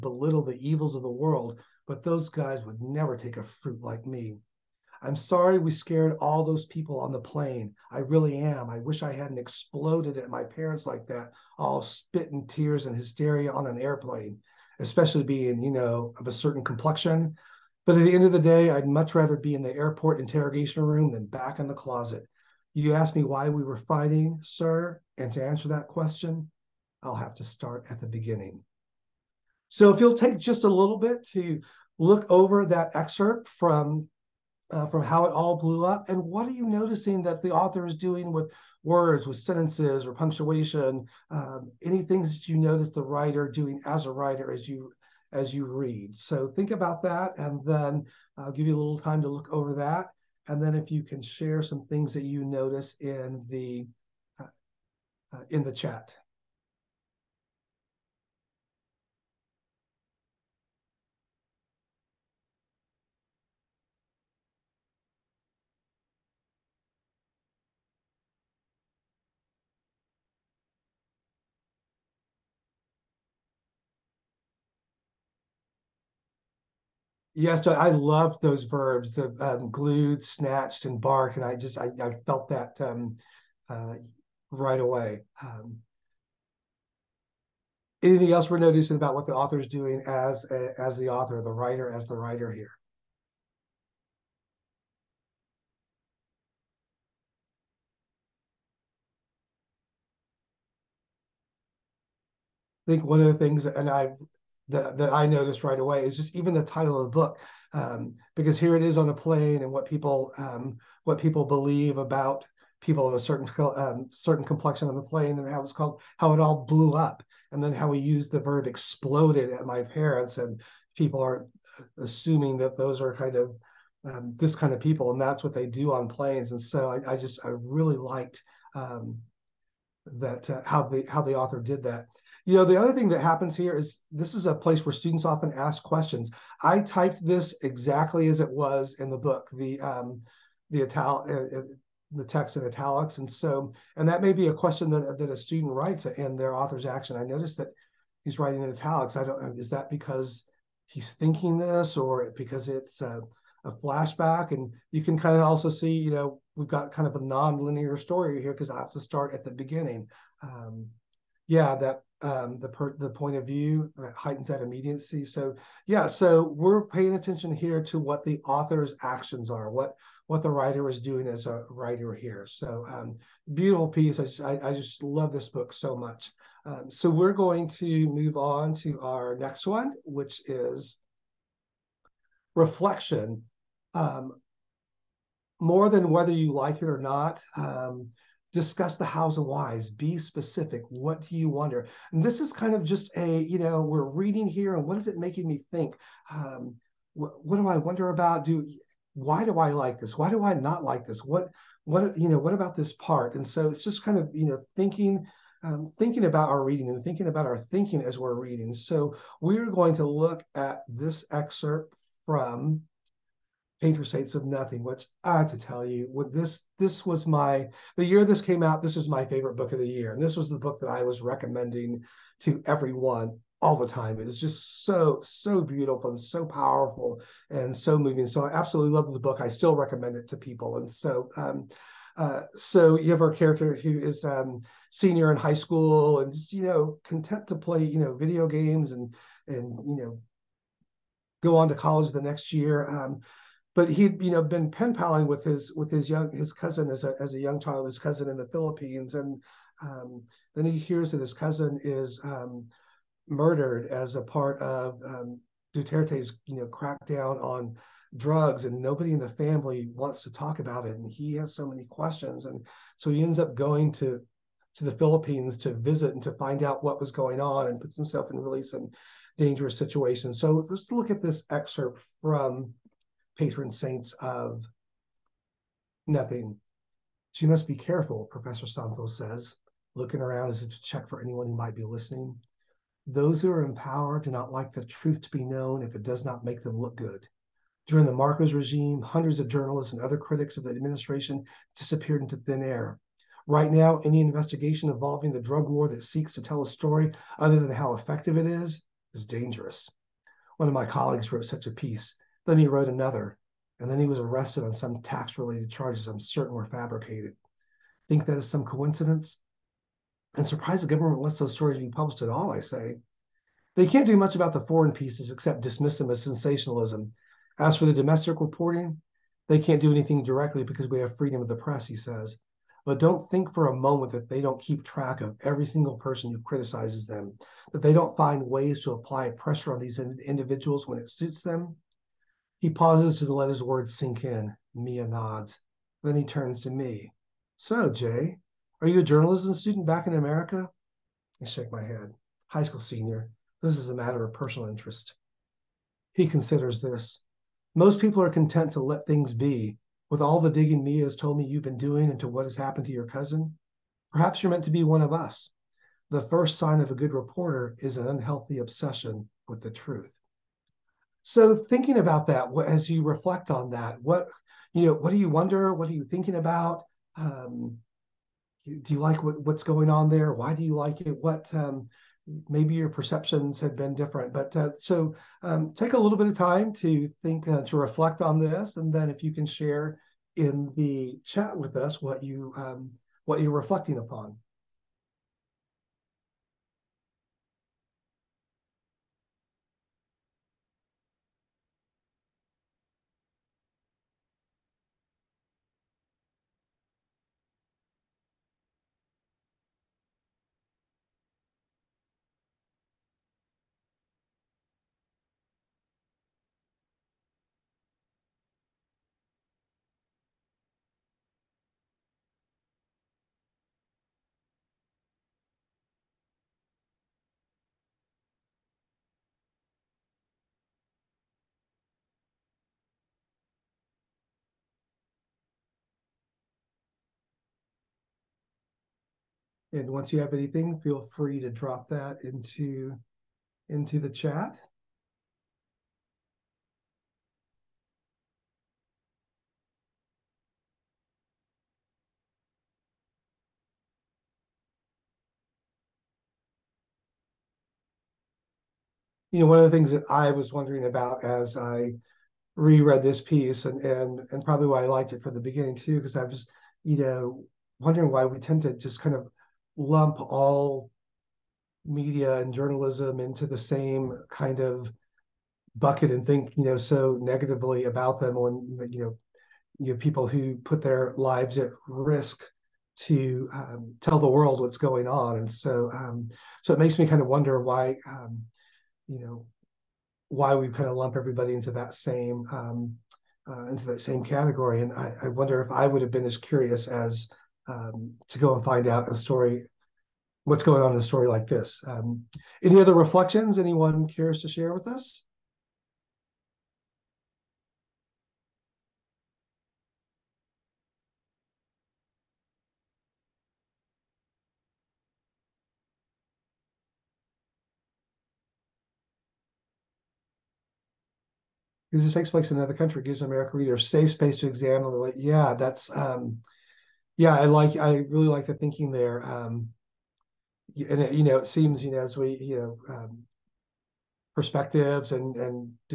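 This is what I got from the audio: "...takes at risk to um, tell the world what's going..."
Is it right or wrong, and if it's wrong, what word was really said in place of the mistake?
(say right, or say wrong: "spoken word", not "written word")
wrong: "lives", not "takes".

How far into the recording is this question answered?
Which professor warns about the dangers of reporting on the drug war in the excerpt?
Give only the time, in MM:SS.
04:38.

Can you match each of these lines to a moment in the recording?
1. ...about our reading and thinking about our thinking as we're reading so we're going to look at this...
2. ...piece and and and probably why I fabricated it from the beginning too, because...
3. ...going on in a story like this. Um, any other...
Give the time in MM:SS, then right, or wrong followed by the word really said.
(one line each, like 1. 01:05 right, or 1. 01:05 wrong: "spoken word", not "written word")
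1. 03:26 right
2. 07:33 wrong: "liked", not "fabricated"
3. 08:10 right.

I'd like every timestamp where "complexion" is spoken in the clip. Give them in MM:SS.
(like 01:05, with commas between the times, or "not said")
00:16, 01:54.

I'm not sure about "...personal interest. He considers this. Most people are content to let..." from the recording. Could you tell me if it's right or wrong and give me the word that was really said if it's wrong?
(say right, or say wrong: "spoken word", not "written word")
right.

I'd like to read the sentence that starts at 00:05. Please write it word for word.
I'm sorry we scared all those people on the plane.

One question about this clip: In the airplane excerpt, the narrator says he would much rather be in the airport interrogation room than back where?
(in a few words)
the closet.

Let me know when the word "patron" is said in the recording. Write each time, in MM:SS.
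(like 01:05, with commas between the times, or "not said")
03:33, 04:33.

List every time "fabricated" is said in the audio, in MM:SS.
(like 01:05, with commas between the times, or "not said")
05:06.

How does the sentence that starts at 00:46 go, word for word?
So think about that, and then I'll give you a little time to look over that.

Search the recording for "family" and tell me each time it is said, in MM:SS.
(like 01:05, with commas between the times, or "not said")
04:19.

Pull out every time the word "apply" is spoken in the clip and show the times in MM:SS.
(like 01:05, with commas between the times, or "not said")
05:28.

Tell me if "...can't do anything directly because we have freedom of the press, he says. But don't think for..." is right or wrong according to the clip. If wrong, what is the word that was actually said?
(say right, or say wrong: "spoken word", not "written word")
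right.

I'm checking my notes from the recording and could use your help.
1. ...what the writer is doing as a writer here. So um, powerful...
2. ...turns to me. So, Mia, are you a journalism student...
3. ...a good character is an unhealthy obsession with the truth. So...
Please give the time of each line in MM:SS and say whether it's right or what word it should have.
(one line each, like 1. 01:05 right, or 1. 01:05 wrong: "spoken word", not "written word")
1. 02:50 wrong: "beautiful", not "powerful"
2. 05:36 wrong: "Jay", not "Mia"
3. 05:56 wrong: "reporter", not "character".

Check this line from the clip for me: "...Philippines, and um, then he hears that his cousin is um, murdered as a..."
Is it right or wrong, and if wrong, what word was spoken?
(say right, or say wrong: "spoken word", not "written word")
right.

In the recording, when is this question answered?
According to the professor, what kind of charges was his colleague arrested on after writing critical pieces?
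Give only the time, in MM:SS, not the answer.
05:05.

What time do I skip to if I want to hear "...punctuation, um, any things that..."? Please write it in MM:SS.
00:40.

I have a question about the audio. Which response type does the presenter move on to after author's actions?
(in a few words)
Reflection.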